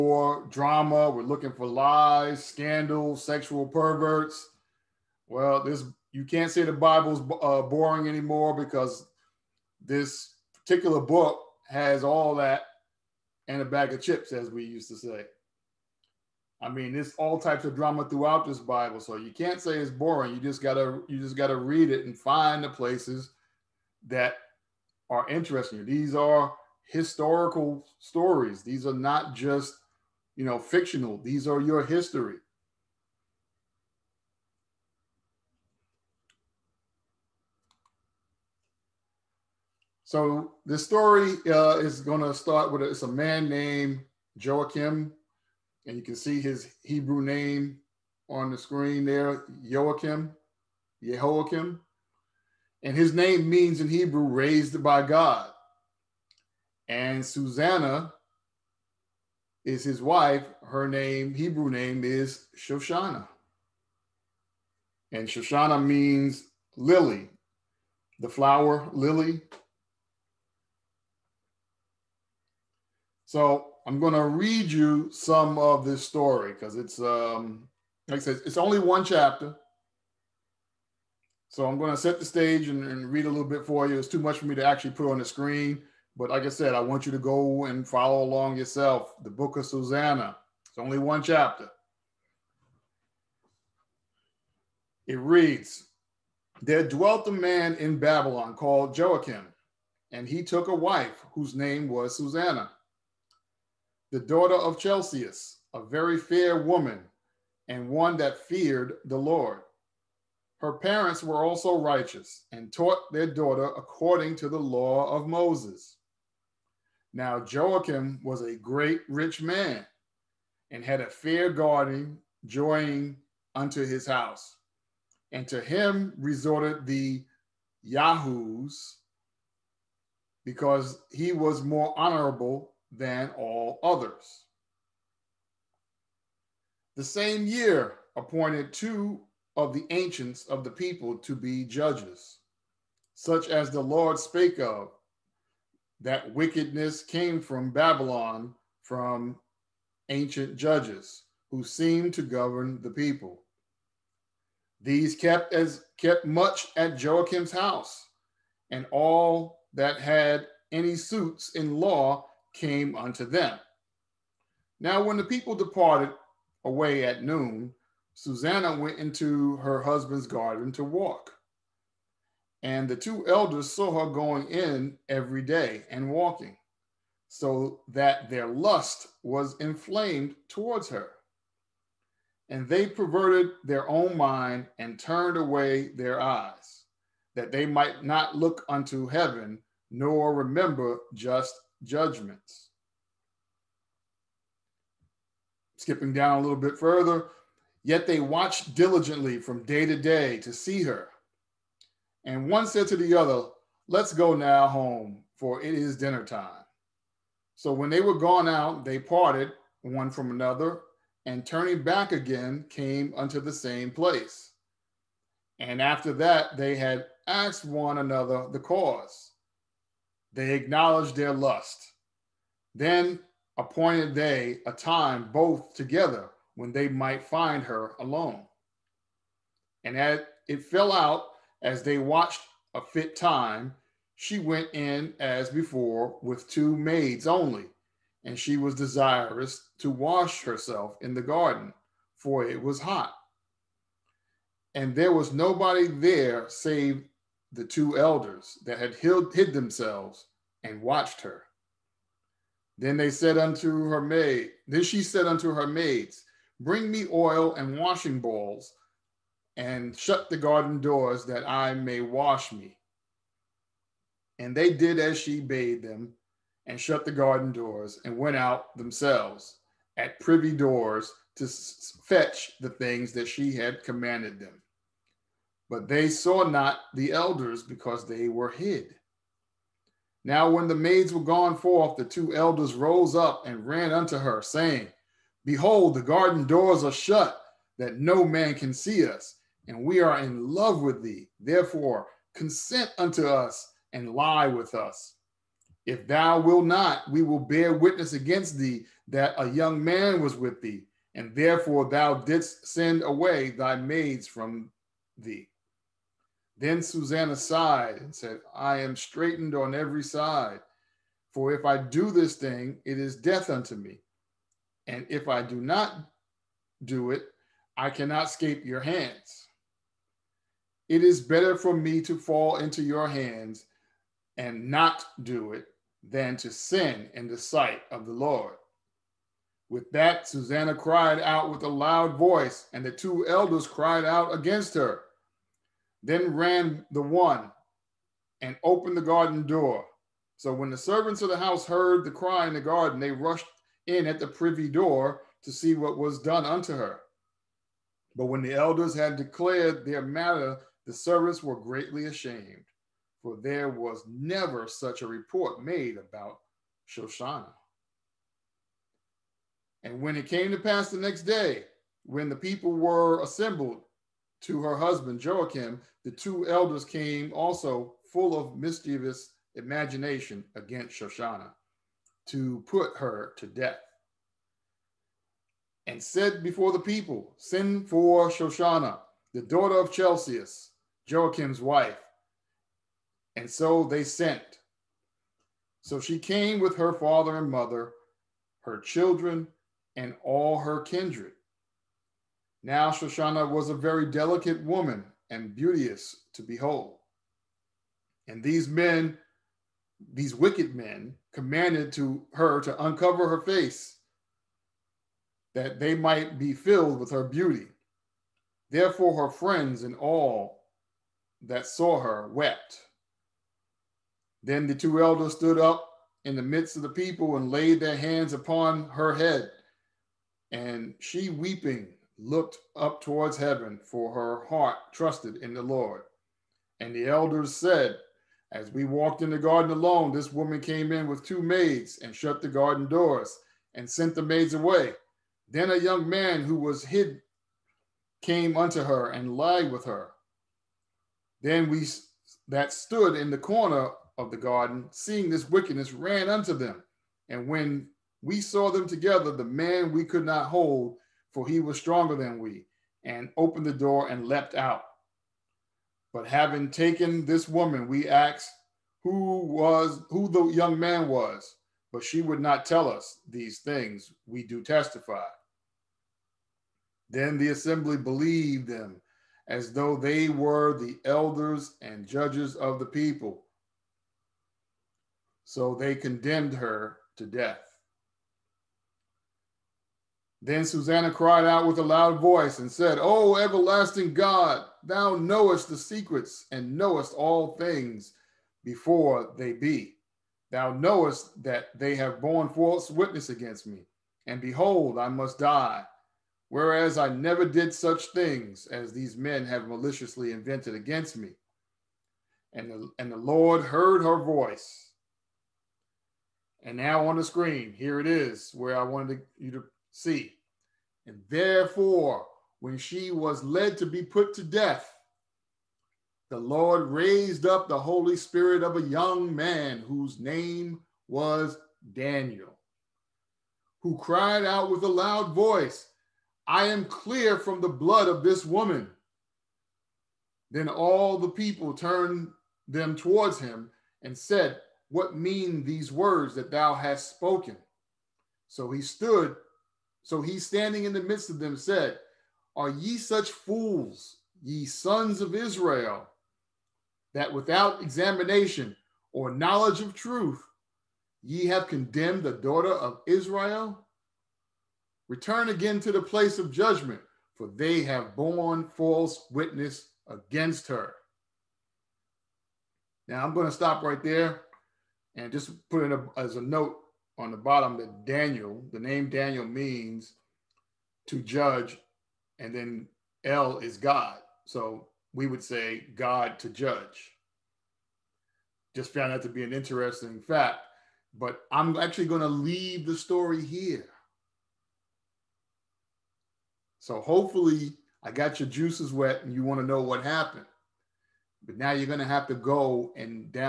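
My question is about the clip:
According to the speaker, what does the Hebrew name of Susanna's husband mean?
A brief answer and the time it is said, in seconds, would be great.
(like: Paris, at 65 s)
Raised by God, at 54 s.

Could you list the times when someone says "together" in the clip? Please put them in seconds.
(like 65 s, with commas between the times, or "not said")
225 s, 448 s.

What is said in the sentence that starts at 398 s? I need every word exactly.
And these men, these wicked men, commanded to her to uncover her face, that they might be filled with her beauty.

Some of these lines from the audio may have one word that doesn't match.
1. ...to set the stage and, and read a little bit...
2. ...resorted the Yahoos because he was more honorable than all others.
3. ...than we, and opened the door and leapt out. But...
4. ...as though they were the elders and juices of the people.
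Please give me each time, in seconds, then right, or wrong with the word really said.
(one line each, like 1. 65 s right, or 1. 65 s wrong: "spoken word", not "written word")
1. 81 s right
2. 126 s right
3. 452 s right
4. 469 s wrong: "judges", not "juices".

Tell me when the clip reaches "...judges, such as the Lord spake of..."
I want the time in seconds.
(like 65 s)
141 s.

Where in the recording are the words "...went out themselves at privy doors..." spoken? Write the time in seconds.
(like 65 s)
268 s.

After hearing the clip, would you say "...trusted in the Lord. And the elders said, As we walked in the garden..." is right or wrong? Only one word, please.
right.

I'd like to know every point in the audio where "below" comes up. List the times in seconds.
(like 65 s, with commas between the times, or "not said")
not said.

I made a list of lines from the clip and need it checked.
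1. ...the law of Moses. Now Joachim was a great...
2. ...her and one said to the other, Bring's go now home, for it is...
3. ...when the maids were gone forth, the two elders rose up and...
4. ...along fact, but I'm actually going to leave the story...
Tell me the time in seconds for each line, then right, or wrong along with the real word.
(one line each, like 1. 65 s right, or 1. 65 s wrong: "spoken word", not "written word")
1. 114 s right
2. 200 s wrong: "Let", not "Bring"
3. 280 s right
4. 579 s wrong: "interesting", not "along".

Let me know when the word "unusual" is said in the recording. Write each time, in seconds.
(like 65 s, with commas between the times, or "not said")
not said.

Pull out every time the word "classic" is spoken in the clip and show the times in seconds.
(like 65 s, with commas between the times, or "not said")
not said.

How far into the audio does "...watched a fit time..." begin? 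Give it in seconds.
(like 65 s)
231 s.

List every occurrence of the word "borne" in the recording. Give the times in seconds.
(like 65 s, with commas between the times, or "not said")
492 s, 558 s.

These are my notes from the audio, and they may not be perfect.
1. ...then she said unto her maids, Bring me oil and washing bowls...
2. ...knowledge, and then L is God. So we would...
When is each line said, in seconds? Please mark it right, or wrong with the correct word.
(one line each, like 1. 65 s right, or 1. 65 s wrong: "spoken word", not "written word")
1. 254 s right
2. 571 s wrong: "judge", not "knowledge".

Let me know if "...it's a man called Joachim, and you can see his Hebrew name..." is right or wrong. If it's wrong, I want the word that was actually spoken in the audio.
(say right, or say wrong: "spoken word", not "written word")
wrong: "named", not "called".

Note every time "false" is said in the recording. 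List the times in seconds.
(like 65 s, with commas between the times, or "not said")
492 s, 558 s.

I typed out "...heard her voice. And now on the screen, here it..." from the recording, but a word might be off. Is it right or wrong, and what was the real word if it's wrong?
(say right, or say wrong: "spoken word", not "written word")
right.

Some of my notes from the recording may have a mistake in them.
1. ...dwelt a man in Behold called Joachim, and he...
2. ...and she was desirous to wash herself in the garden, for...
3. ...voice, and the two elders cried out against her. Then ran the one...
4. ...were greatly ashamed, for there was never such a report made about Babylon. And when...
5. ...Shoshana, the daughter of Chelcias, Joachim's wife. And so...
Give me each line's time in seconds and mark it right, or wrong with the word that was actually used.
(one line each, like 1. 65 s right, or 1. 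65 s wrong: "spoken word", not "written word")
1. 96 s wrong: "Babylon", not "Behold"
2. 238 s right
3. 332 s right
4. 351 s wrong: "Shoshana", not "Babylon"
5. 378 s right.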